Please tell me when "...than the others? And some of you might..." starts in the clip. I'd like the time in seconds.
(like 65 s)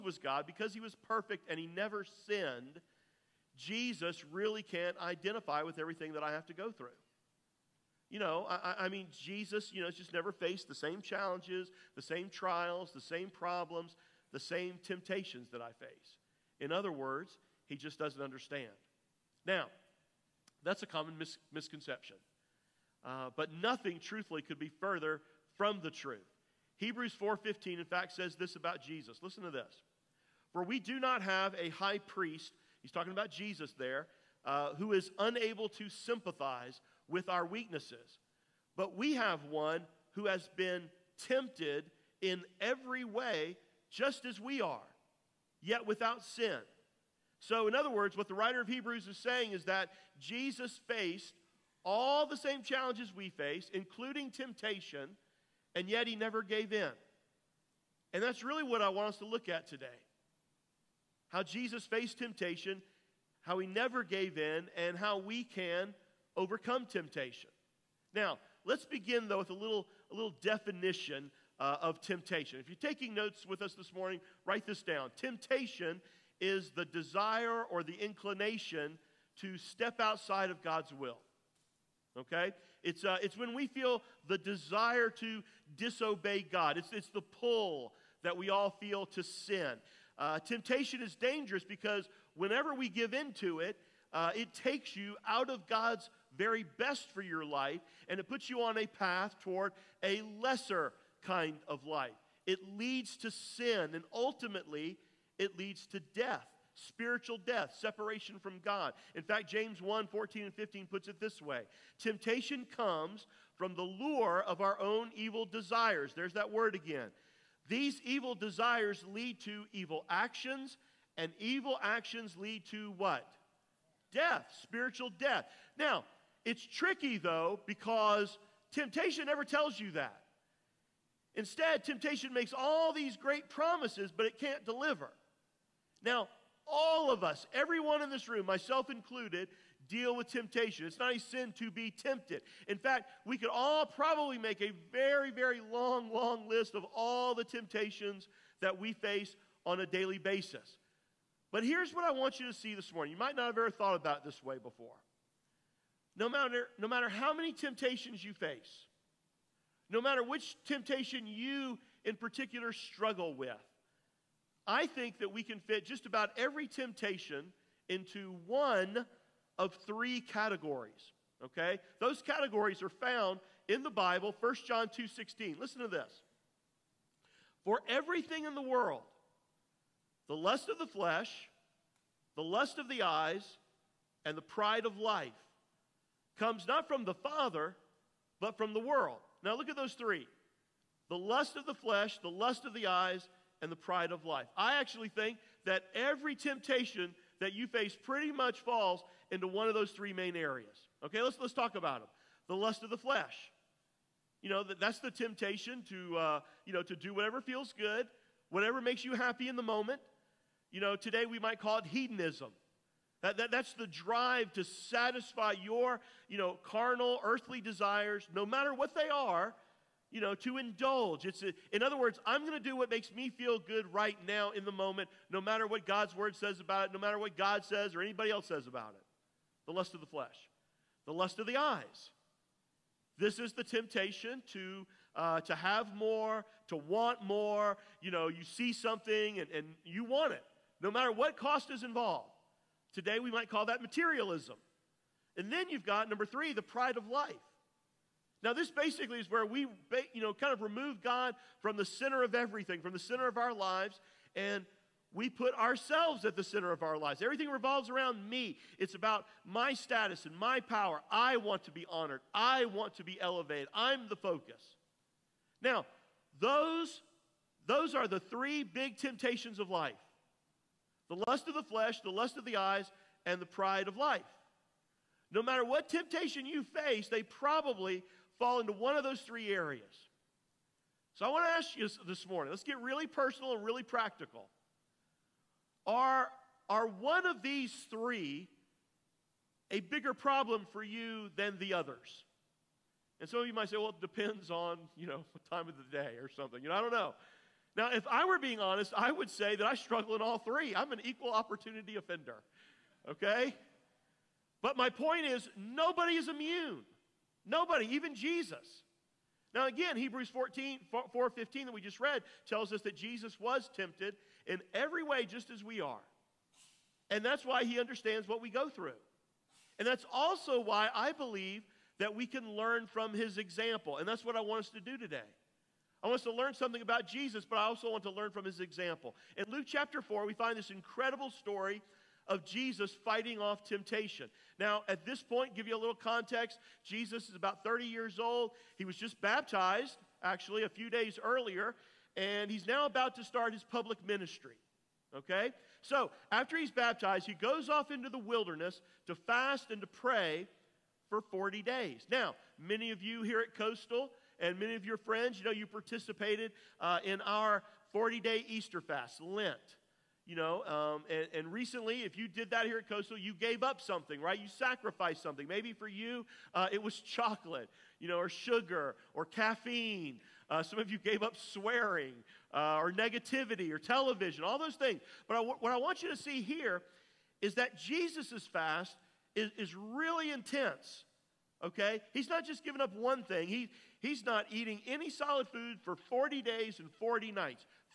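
291 s.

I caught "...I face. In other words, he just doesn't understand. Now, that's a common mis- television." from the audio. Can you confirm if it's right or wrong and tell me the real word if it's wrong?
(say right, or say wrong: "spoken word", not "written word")
wrong: "misconception", not "television".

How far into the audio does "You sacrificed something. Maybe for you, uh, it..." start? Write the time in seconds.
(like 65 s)
364 s.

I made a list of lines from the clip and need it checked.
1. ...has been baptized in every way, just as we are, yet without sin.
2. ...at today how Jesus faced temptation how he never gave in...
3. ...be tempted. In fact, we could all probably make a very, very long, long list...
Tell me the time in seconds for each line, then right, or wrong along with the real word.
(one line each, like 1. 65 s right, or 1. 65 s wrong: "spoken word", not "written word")
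1. 40 s wrong: "tempted", not "baptized"
2. 59 s right
3. 141 s right.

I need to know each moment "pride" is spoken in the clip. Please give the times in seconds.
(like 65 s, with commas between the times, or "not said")
184 s, 193 s, 246 s, 273 s.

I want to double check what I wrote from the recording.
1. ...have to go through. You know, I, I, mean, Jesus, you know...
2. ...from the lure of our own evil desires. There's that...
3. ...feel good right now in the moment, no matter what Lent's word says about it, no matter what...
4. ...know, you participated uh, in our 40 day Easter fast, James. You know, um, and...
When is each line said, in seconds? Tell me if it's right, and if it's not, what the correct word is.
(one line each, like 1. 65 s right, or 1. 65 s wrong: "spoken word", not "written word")
1. 6 s right
2. 113 s right
3. 223 s wrong: "God", not "Lent"
4. 355 s wrong: "Lent", not "James".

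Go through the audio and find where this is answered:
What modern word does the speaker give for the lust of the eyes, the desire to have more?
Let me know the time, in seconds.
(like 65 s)
243 s.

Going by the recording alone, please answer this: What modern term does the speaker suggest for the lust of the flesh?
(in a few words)
hedonism.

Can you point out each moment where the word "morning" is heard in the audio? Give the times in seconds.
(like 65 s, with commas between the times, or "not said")
73 s, 152 s, 282 s.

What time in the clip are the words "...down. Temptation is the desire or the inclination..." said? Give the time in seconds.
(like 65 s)
74 s.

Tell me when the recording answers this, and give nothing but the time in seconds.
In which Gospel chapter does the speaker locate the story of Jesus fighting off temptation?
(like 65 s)
329 s.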